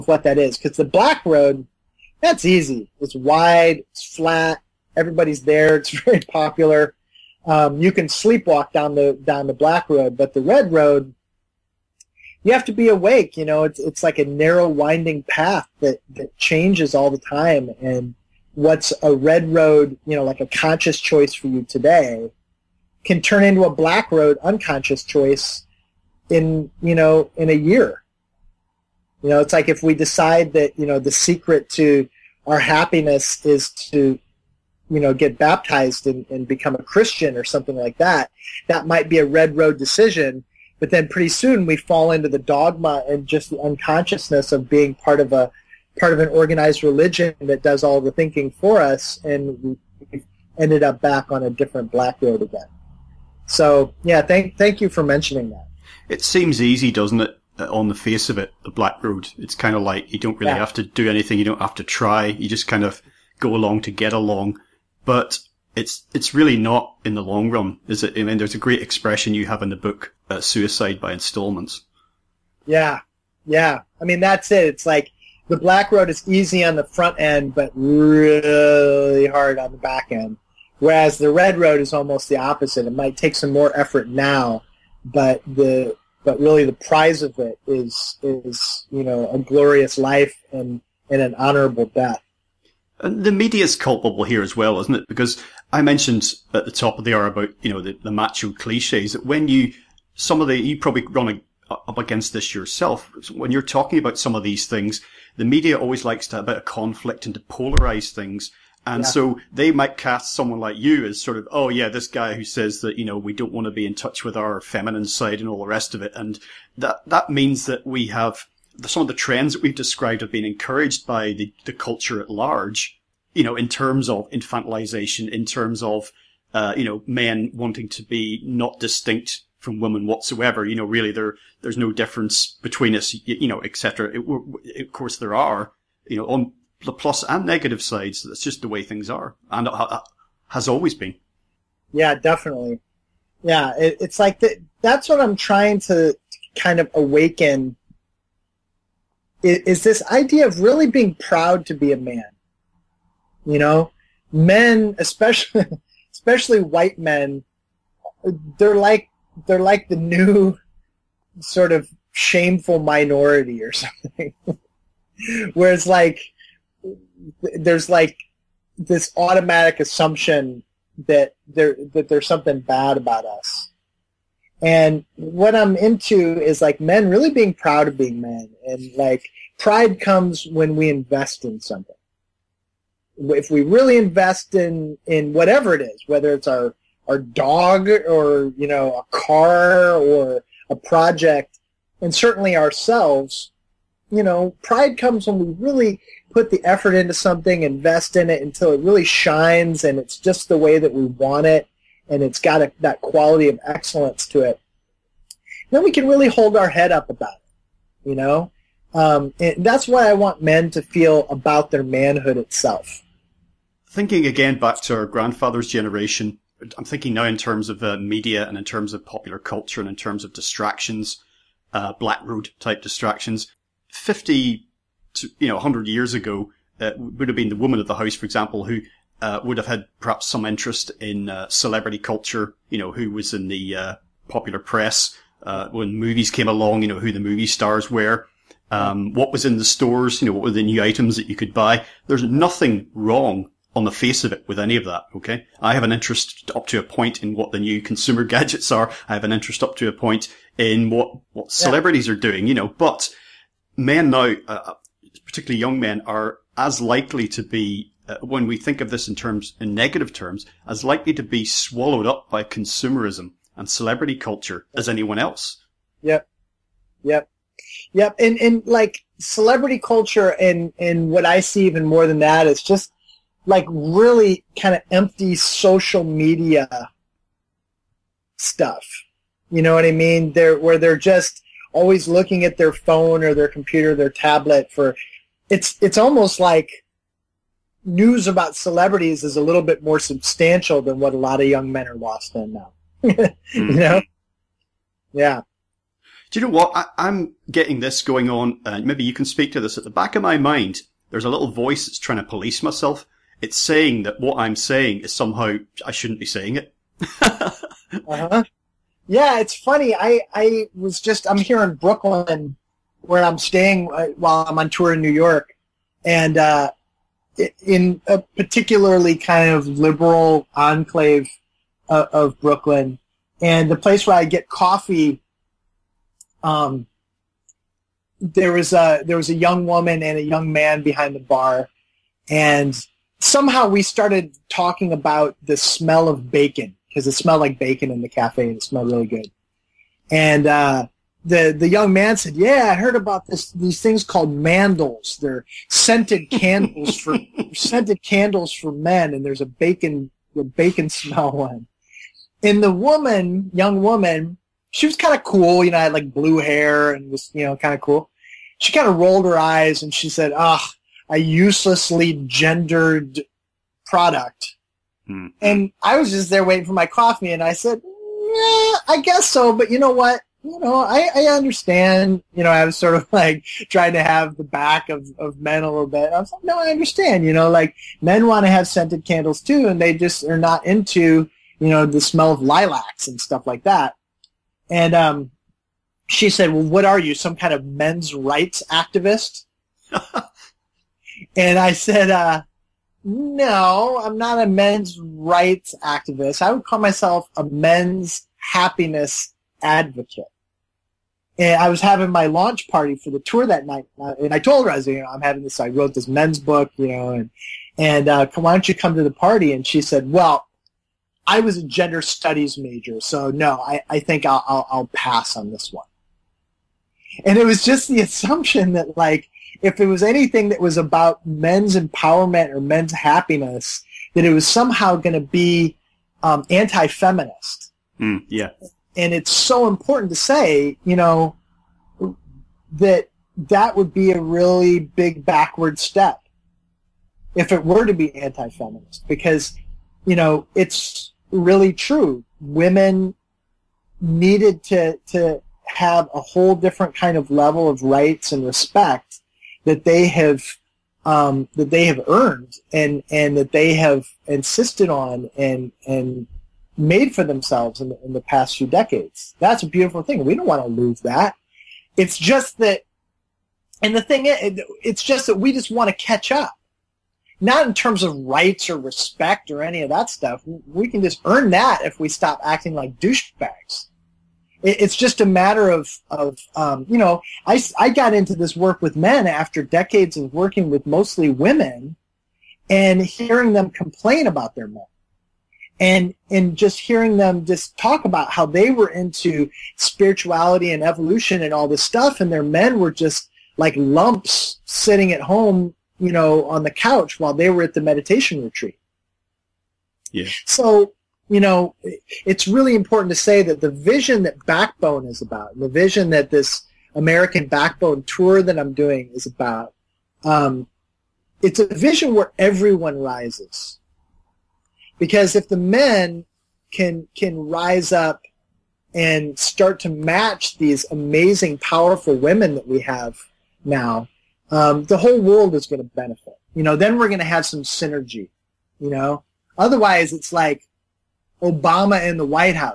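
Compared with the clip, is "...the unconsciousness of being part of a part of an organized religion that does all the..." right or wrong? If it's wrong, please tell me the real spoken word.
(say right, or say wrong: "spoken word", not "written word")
right.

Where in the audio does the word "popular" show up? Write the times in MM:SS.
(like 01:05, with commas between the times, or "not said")
00:06, 03:39, 03:54.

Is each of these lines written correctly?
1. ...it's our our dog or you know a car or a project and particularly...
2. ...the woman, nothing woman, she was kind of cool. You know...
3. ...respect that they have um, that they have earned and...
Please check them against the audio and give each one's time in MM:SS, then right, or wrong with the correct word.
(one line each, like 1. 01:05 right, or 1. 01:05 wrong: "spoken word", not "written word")
1. 03:06 wrong: "certainly", not "particularly"
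2. 05:52 wrong: "young", not "nothing"
3. 07:28 right.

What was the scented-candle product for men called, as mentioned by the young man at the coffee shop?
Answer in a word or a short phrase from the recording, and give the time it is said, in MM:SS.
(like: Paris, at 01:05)
mandals, at 05:44.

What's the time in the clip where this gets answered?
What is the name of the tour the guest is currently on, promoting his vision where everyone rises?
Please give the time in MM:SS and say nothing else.
08:26.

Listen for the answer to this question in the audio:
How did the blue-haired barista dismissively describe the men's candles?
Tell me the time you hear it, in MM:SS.
06:01.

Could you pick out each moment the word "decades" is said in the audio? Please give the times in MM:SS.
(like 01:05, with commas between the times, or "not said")
07:38, 07:59.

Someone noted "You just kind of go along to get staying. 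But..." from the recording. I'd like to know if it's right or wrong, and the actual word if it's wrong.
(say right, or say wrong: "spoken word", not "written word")
wrong: "along", not "staying".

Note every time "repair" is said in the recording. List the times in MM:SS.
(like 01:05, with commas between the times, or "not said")
not said.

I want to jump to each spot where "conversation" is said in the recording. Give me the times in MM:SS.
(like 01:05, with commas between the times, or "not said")
not said.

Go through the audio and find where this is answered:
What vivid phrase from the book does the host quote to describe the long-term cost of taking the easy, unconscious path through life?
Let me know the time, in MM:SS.
01:10.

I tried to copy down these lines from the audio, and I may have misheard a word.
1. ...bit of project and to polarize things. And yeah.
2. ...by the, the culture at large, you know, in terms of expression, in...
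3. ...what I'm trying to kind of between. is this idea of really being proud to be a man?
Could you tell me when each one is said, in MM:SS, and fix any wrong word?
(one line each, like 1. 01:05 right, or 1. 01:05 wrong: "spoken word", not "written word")
1. 01:46 wrong: "conflict", not "project"
2. 02:01 wrong: "infantilization", not "expression"
3. 02:25 wrong: "awaken", not "between".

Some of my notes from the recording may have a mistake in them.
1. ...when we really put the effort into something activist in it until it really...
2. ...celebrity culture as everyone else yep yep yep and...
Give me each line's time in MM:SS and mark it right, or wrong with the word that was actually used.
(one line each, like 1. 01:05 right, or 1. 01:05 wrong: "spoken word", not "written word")
1. 03:15 wrong: "invest", not "activist"
2. 04:23 wrong: "anyone", not "everyone".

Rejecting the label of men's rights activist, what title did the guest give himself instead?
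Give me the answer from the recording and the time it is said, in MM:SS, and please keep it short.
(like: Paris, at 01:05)
men's happiness advocate, at 06:37.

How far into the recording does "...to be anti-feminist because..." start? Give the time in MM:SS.
07:17.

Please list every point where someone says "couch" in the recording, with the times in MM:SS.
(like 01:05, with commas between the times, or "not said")
08:16.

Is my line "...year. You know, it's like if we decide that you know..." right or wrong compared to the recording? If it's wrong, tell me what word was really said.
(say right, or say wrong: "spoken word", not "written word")
right.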